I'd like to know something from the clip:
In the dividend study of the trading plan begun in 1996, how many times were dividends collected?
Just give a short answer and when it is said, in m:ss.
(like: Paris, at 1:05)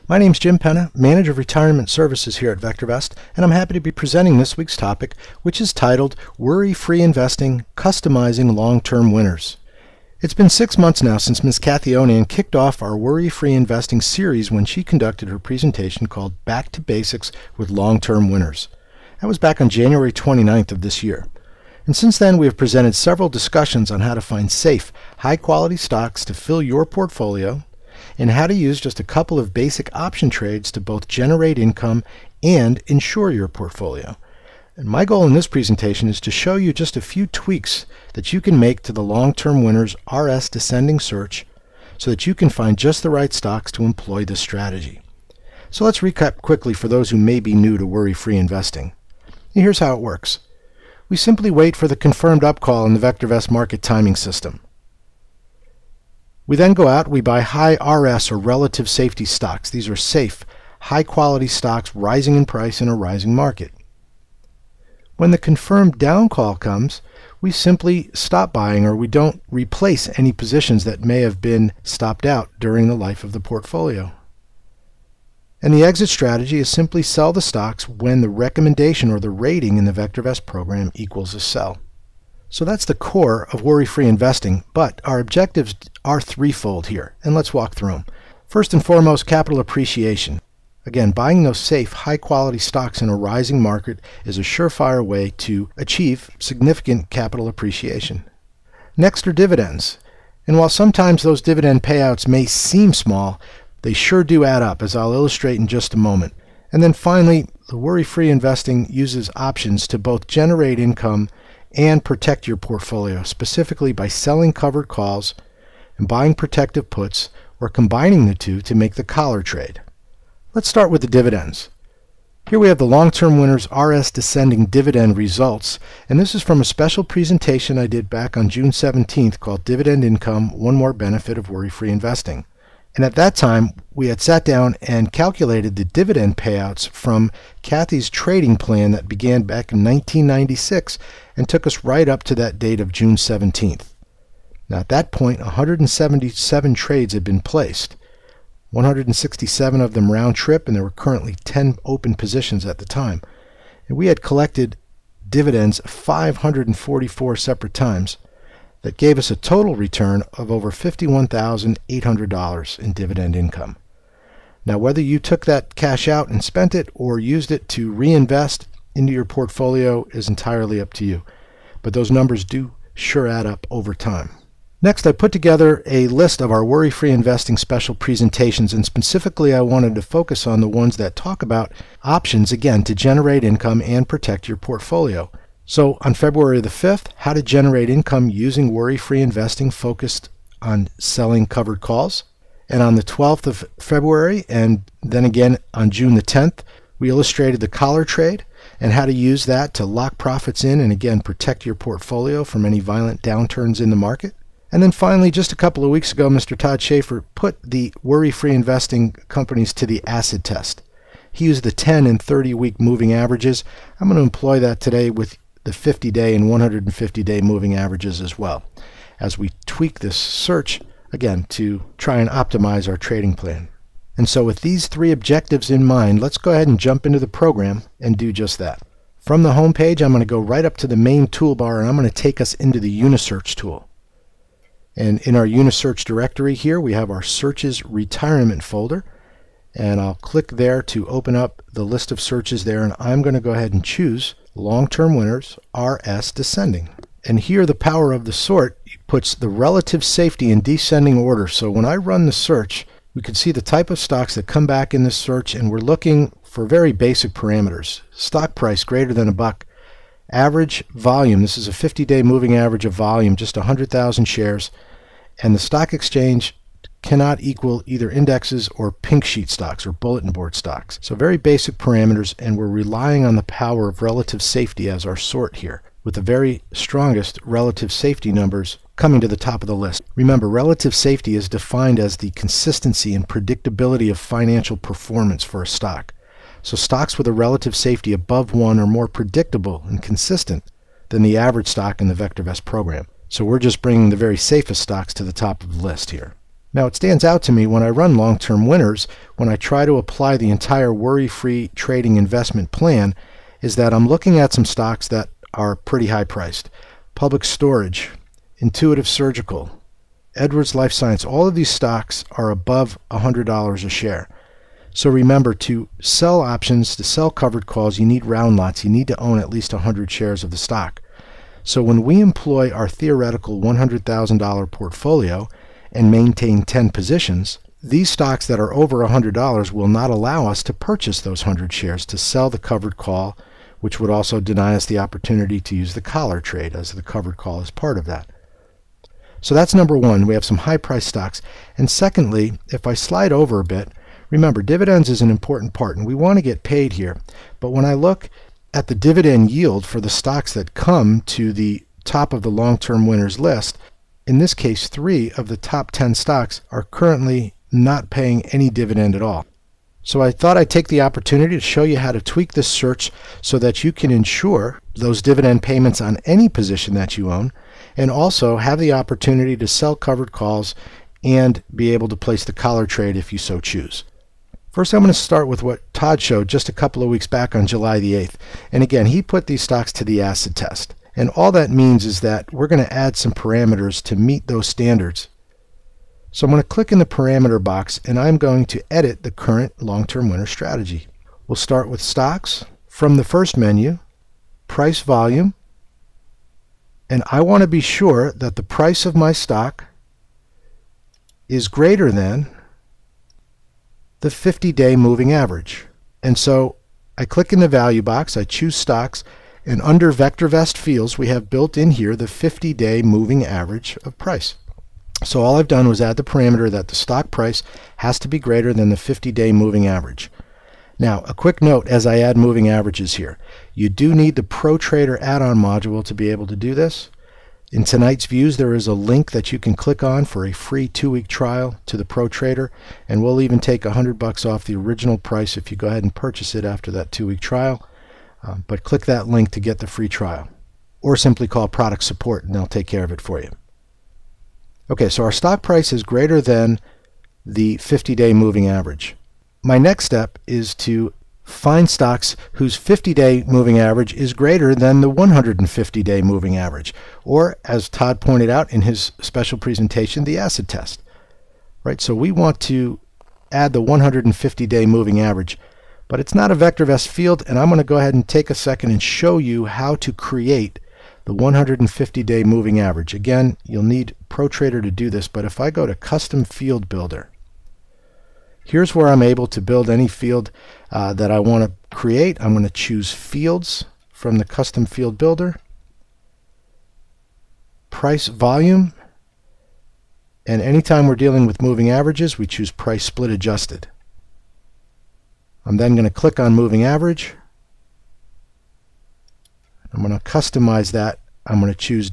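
544, at 2:35.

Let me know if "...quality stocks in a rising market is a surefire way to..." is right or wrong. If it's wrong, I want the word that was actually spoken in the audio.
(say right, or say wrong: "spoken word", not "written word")
right.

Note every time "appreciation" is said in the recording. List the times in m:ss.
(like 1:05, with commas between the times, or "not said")
1:29, 1:37.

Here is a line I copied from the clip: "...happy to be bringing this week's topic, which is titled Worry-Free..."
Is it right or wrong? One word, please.
wrong.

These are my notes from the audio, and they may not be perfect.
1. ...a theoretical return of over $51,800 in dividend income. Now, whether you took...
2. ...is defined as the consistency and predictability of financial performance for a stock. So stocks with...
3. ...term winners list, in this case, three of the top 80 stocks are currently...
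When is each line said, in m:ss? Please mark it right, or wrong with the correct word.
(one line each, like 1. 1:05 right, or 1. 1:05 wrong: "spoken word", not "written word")
1. 2:39 wrong: "total", not "theoretical"
2. 4:41 right
3. 5:52 wrong: "10", not "80".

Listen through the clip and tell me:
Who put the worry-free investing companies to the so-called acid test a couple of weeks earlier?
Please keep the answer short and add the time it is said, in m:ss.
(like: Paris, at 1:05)
Todd Schaefer, at 3:26.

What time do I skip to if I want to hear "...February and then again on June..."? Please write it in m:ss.
3:13.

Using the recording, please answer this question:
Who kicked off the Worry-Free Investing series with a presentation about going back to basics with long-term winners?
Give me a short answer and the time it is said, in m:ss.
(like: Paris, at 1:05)
Kathy Onan, at 0:11.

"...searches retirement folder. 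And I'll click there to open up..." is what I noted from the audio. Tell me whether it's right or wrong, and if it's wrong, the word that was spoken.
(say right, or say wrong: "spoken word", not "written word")
right.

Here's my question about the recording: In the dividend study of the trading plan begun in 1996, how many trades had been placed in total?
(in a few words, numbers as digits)
177.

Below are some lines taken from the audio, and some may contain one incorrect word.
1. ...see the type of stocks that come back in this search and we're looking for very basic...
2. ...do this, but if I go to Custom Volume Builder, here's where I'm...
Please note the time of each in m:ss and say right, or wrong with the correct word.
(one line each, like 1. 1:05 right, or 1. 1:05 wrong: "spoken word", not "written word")
1. 4:13 right
2. 7:54 wrong: "Field", not "Volume".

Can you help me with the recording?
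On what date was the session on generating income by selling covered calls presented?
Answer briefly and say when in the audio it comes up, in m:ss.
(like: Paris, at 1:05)
February 5th, at 3:06.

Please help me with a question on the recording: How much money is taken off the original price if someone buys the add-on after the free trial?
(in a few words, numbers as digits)
$100.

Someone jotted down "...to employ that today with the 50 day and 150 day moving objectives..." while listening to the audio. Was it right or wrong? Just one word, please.
wrong.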